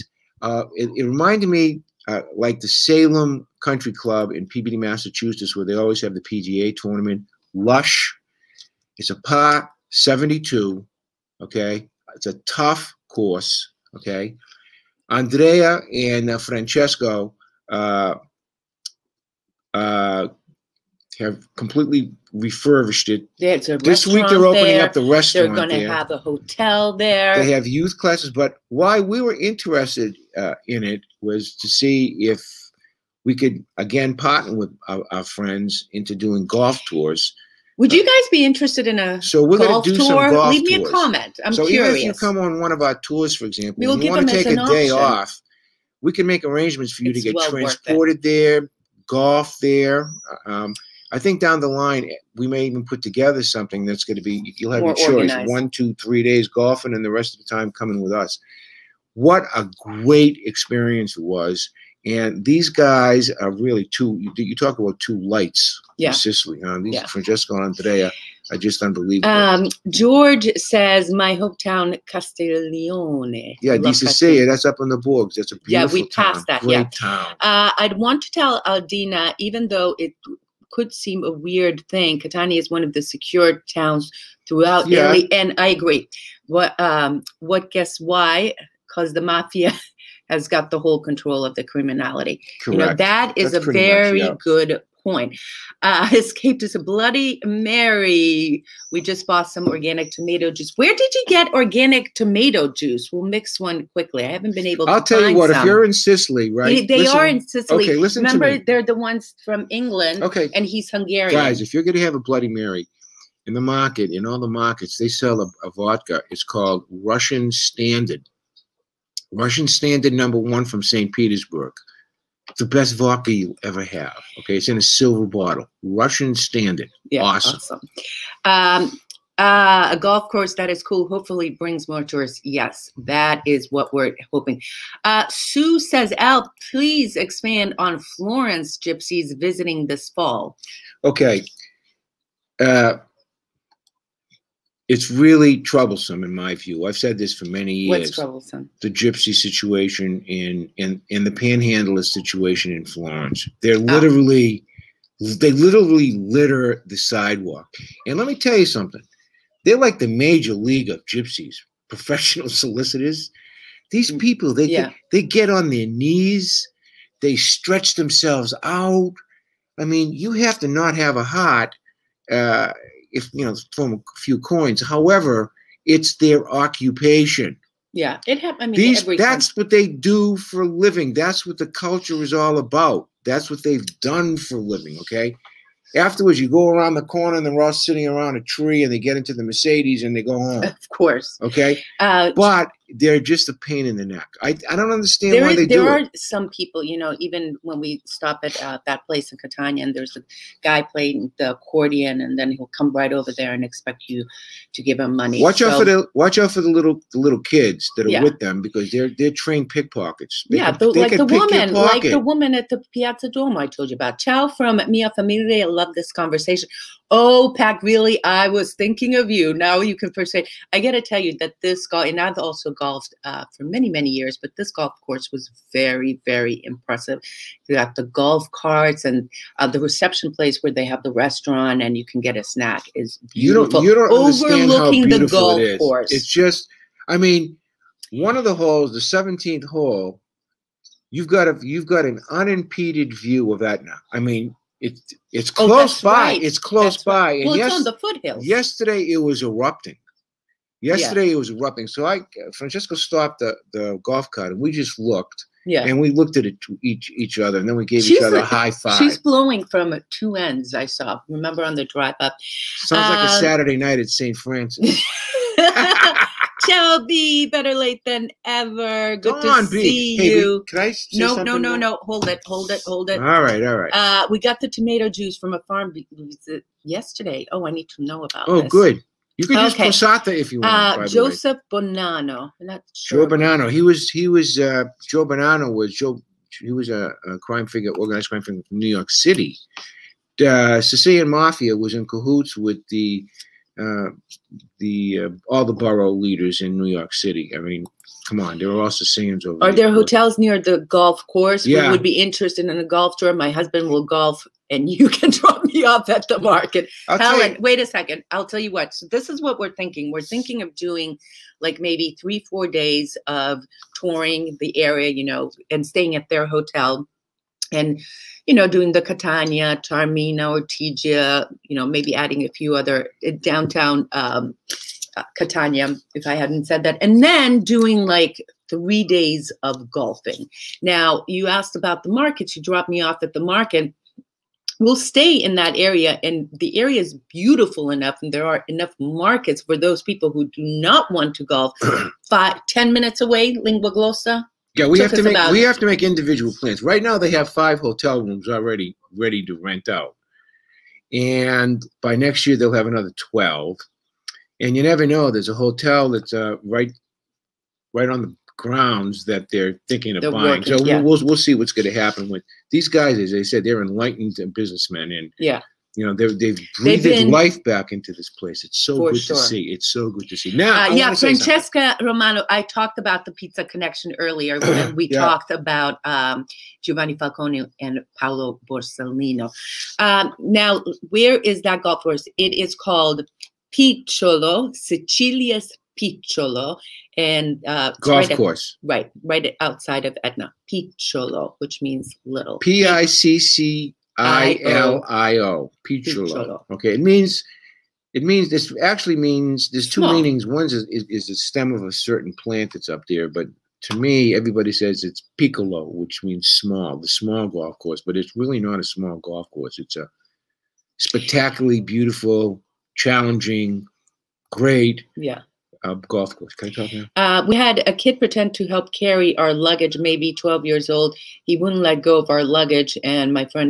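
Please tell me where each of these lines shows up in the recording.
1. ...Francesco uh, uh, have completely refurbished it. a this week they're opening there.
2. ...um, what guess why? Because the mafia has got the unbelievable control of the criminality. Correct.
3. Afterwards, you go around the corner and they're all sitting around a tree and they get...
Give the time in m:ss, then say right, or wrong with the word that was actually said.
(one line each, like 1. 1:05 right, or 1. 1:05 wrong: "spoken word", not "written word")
1. 0:16 right
2. 1:26 wrong: "whole", not "unbelievable"
3. 3:05 right.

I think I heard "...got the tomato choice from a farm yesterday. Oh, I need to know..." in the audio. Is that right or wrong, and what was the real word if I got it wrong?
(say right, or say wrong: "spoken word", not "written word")
wrong: "juice", not "choice".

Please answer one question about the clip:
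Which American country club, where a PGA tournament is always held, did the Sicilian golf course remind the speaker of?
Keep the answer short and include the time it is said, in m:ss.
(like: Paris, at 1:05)
Salem Country Club, at 0:02.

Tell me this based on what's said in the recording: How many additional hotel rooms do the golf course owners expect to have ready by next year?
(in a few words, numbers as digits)
12.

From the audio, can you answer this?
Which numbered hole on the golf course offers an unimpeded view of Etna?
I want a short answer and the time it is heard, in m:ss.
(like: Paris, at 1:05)
17th, at 3:58.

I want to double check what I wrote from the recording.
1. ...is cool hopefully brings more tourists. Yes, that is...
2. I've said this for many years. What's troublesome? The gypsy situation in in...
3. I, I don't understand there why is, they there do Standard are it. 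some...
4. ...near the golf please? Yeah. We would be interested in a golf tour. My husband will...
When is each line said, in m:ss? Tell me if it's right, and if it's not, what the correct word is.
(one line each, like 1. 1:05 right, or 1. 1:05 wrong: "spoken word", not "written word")
1. 2:10 right
2. 2:26 right
3. 3:14 wrong: "There", not "Standard"
4. 5:00 wrong: "course", not "please".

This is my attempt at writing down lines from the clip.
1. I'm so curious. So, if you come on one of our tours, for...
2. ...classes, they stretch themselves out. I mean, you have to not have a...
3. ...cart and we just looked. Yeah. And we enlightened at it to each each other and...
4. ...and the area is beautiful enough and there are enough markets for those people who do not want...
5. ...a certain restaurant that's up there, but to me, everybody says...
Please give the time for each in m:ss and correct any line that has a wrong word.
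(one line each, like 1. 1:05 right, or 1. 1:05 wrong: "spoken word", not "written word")
1. 0:41 right
2. 2:45 wrong: "knees", not "classes"
3. 4:14 wrong: "looked", not "enlightened"
4. 5:36 right
5. 6:41 wrong: "plant", not "restaurant".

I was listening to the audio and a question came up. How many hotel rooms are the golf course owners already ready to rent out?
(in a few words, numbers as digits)
5.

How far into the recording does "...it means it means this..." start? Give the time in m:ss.
6:36.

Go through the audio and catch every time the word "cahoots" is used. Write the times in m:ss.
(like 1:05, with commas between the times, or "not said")
4:52.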